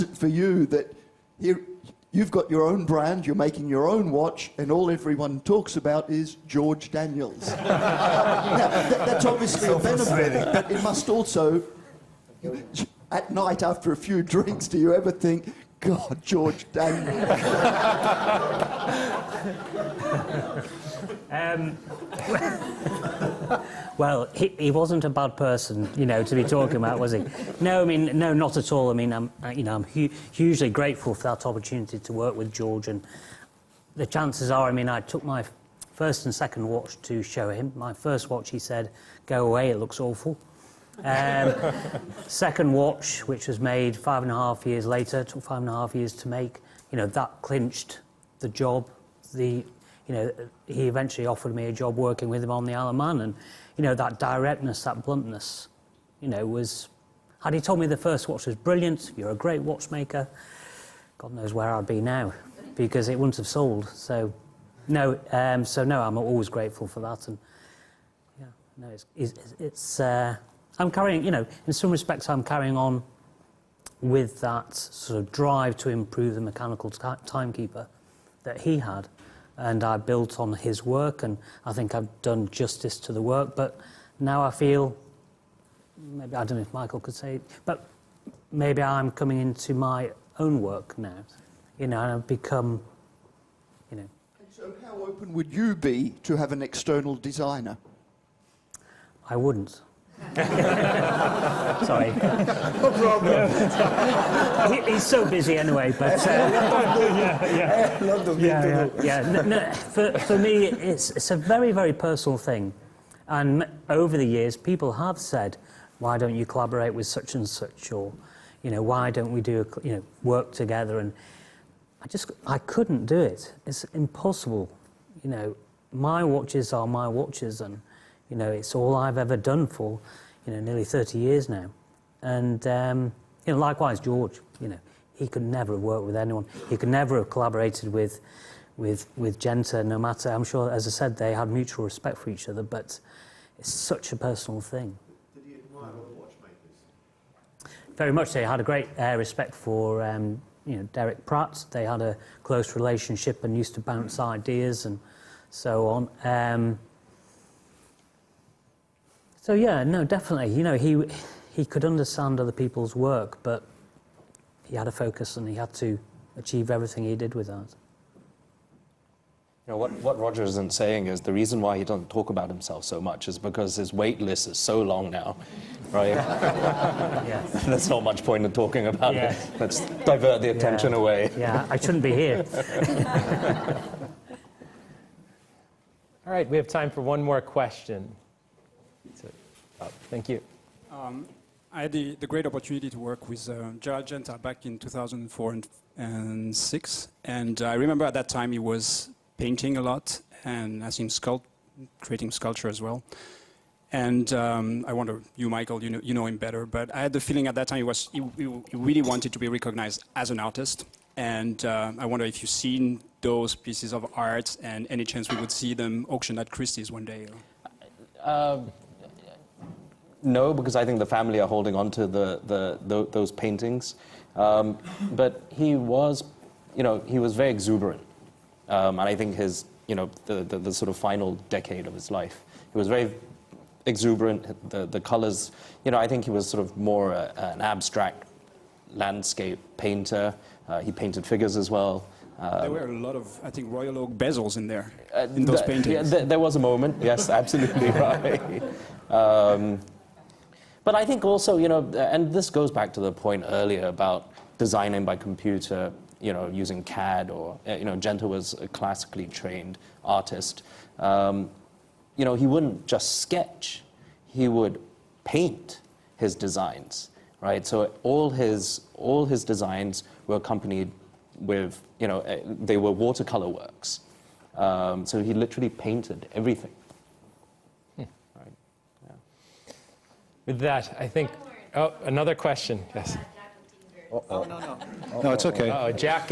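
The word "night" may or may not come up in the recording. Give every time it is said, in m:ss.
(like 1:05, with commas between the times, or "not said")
0:13.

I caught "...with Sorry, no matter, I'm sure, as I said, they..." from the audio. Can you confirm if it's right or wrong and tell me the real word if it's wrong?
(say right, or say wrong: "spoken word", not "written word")
wrong: "Genta", not "Sorry".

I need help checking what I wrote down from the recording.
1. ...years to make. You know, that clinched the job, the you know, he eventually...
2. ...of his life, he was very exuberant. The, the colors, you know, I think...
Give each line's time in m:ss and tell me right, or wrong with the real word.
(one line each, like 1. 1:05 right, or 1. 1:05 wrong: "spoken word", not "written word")
1. 0:45 right
2. 3:51 right.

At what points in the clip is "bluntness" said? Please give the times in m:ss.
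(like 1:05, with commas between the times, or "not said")
0:55.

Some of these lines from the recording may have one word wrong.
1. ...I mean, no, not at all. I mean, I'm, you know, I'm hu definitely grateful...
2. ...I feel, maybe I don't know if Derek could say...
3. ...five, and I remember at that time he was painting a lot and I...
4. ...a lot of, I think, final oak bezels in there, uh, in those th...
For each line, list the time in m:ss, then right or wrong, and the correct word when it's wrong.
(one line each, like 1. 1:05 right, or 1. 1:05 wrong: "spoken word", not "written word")
1. 0:27 wrong: "hugely", not "definitely"
2. 1:24 wrong: "Michael", not "Derek"
3. 3:16 wrong: "six", not "five"
4. 4:02 wrong: "royal", not "final".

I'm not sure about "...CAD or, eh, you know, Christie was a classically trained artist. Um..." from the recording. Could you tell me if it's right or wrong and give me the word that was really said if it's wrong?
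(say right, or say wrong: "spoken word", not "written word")
wrong: "Genta", not "Christie".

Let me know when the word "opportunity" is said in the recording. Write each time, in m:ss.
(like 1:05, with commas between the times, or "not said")
0:31, 3:12.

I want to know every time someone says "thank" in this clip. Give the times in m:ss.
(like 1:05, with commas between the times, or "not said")
3:10.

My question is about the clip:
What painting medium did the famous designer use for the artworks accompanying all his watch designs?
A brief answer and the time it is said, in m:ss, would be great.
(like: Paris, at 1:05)
Watercolor, at 4:32.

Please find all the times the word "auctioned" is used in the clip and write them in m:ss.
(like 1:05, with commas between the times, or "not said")
3:36.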